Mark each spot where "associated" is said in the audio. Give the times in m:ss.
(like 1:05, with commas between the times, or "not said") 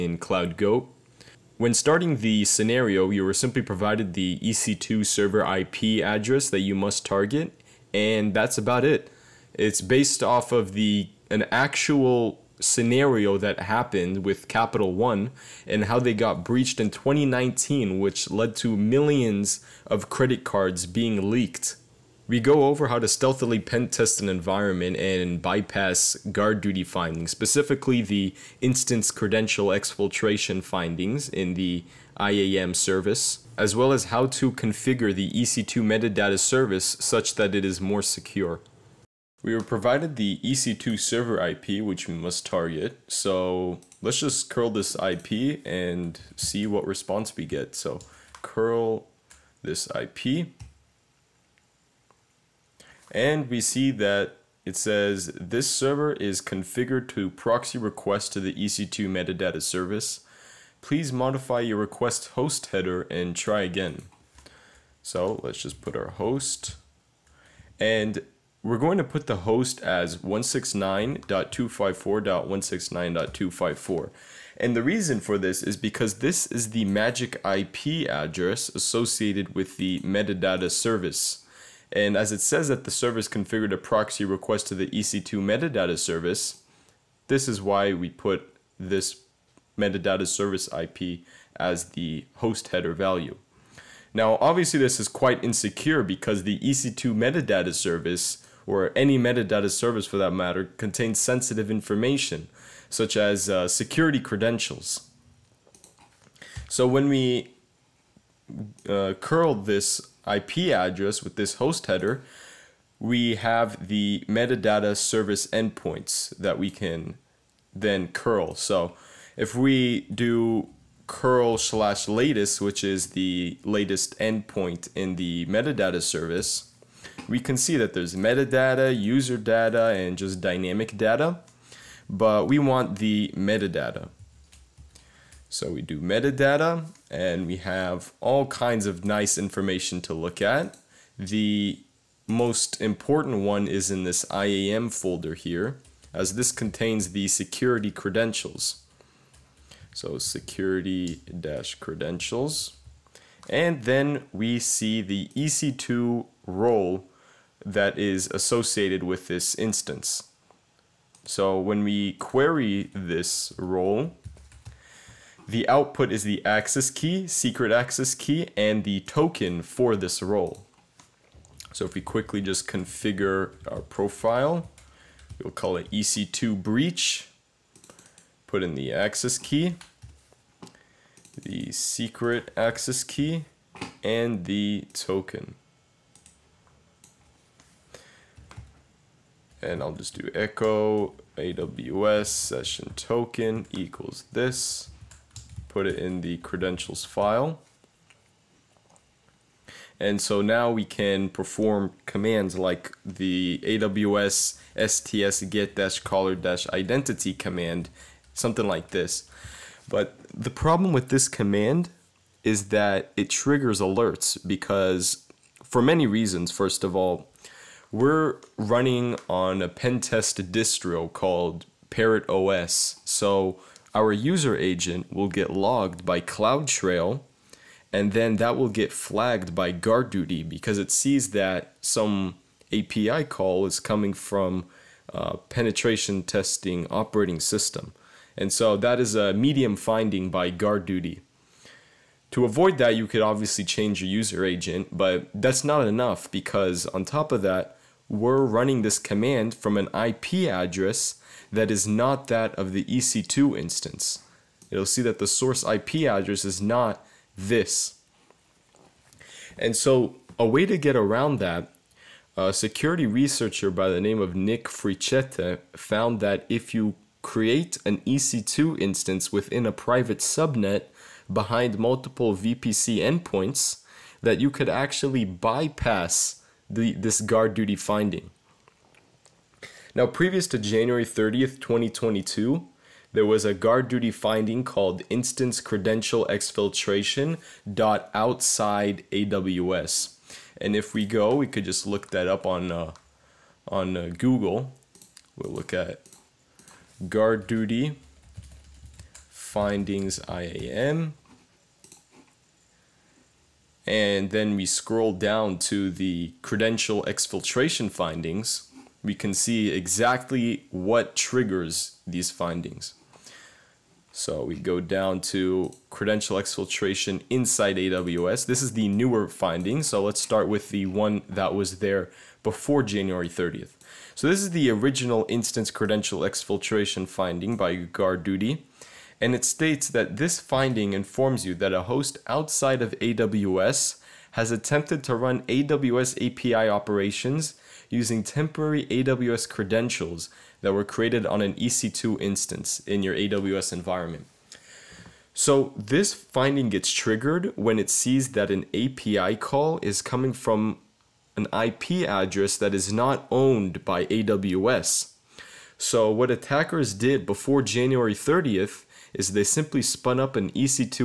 1:18, 2:38.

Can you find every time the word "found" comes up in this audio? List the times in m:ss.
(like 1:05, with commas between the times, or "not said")
4:25.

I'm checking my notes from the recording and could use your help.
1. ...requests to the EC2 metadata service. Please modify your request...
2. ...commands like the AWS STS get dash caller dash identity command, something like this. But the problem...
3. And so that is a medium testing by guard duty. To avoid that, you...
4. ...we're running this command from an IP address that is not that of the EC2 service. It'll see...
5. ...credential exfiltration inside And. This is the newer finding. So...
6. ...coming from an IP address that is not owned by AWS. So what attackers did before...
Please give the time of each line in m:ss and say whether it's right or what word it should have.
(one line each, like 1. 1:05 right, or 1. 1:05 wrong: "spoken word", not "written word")
1. 0:57 right
2. 3:22 right
3. 3:58 wrong: "finding", not "testing"
4. 4:08 wrong: "instance", not "service"
5. 5:15 wrong: "AWS", not "And"
6. 5:50 right.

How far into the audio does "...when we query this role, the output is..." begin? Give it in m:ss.
2:41.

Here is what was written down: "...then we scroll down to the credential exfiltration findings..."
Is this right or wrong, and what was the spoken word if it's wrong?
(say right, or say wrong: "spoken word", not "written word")
right.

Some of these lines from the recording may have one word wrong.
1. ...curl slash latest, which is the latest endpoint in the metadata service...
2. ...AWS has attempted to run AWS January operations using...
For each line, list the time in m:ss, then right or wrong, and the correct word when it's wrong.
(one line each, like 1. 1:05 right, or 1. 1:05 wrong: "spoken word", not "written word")
1. 2:01 right
2. 5:32 wrong: "API", not "January".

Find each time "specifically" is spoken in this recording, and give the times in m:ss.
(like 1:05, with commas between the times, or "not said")
0:27.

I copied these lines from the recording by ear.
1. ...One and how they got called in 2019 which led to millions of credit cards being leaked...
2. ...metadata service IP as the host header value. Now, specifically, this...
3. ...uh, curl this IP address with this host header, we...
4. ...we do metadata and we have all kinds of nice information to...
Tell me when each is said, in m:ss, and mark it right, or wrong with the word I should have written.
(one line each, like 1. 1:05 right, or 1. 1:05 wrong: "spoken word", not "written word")
1. 0:14 wrong: "breached", not "called"
2. 1:29 wrong: "obviously", not "specifically"
3. 1:48 right
4. 2:15 right.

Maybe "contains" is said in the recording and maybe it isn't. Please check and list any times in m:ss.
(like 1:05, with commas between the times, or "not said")
1:40, 2:26.